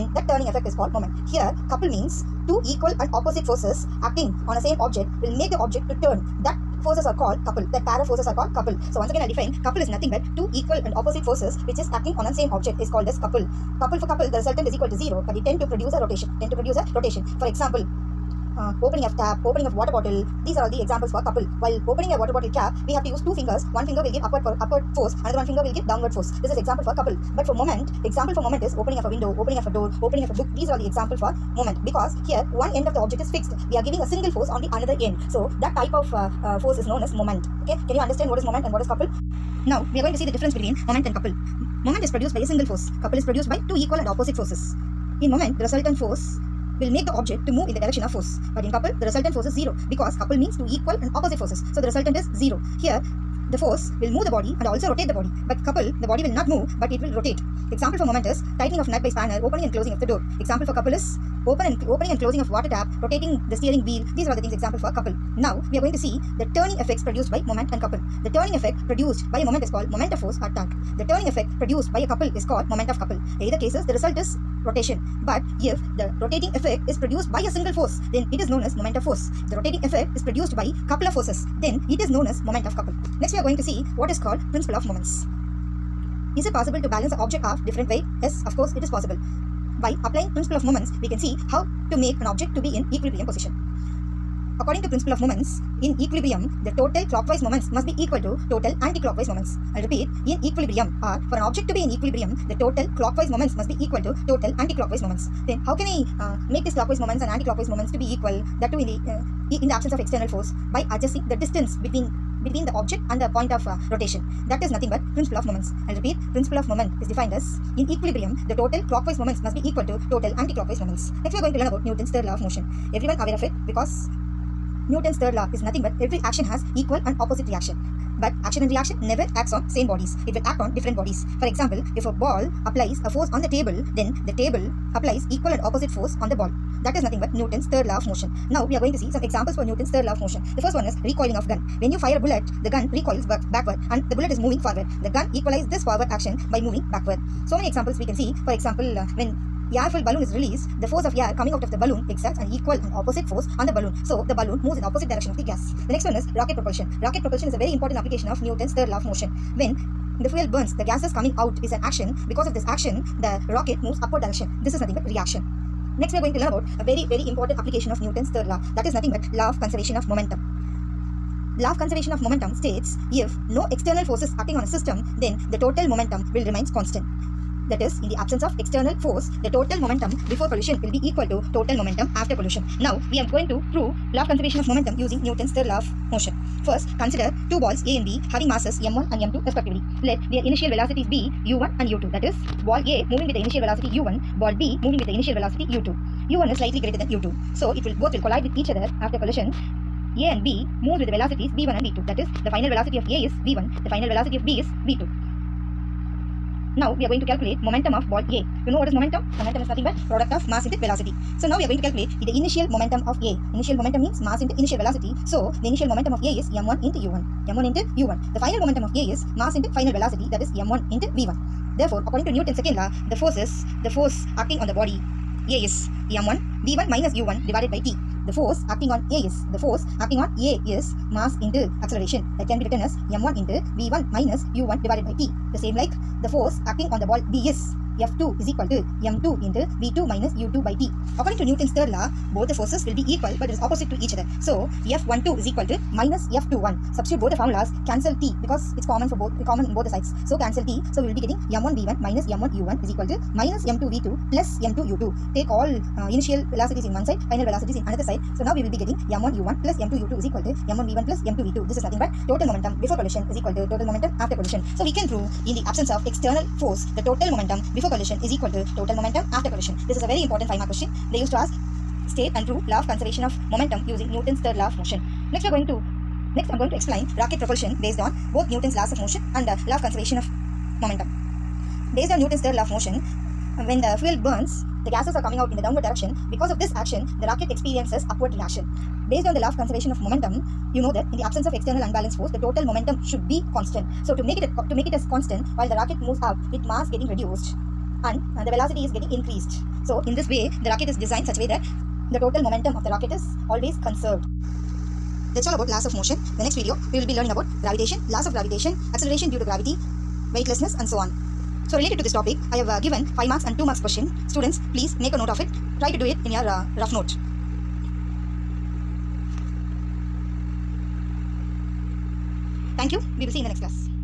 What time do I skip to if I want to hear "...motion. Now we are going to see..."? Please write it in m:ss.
2:18.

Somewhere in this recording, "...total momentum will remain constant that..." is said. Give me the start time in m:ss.
2:55.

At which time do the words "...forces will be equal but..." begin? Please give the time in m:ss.
4:02.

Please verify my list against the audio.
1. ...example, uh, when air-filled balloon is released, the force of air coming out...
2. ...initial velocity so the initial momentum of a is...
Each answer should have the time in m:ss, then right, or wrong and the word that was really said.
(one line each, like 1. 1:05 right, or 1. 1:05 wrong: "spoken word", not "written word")
1. 2:28 right
2. 3:34 right.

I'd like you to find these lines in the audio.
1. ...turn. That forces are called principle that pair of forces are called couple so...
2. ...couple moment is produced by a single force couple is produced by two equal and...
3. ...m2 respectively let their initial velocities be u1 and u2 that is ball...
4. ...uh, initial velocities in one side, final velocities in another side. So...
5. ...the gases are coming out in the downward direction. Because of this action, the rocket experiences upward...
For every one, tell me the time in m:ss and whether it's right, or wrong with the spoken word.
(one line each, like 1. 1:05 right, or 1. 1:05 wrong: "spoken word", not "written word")
1. 0:06 wrong: "couple", not "principle"
2. 0:41 right
3. 3:09 right
4. 4:15 right
5. 4:44 right.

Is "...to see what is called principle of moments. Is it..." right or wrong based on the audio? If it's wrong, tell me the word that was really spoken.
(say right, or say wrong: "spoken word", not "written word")
right.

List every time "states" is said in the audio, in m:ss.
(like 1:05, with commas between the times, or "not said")
2:52, 4:32.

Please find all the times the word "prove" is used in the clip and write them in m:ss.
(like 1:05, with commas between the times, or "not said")
3:03, 4:25, 4:32.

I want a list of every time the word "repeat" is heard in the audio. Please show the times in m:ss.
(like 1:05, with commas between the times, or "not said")
1:39, 1:55.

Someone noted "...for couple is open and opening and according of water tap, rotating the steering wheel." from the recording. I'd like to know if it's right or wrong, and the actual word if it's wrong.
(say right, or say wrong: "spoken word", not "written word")
wrong: "closing", not "according".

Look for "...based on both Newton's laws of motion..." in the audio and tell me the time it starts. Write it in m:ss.
4:37.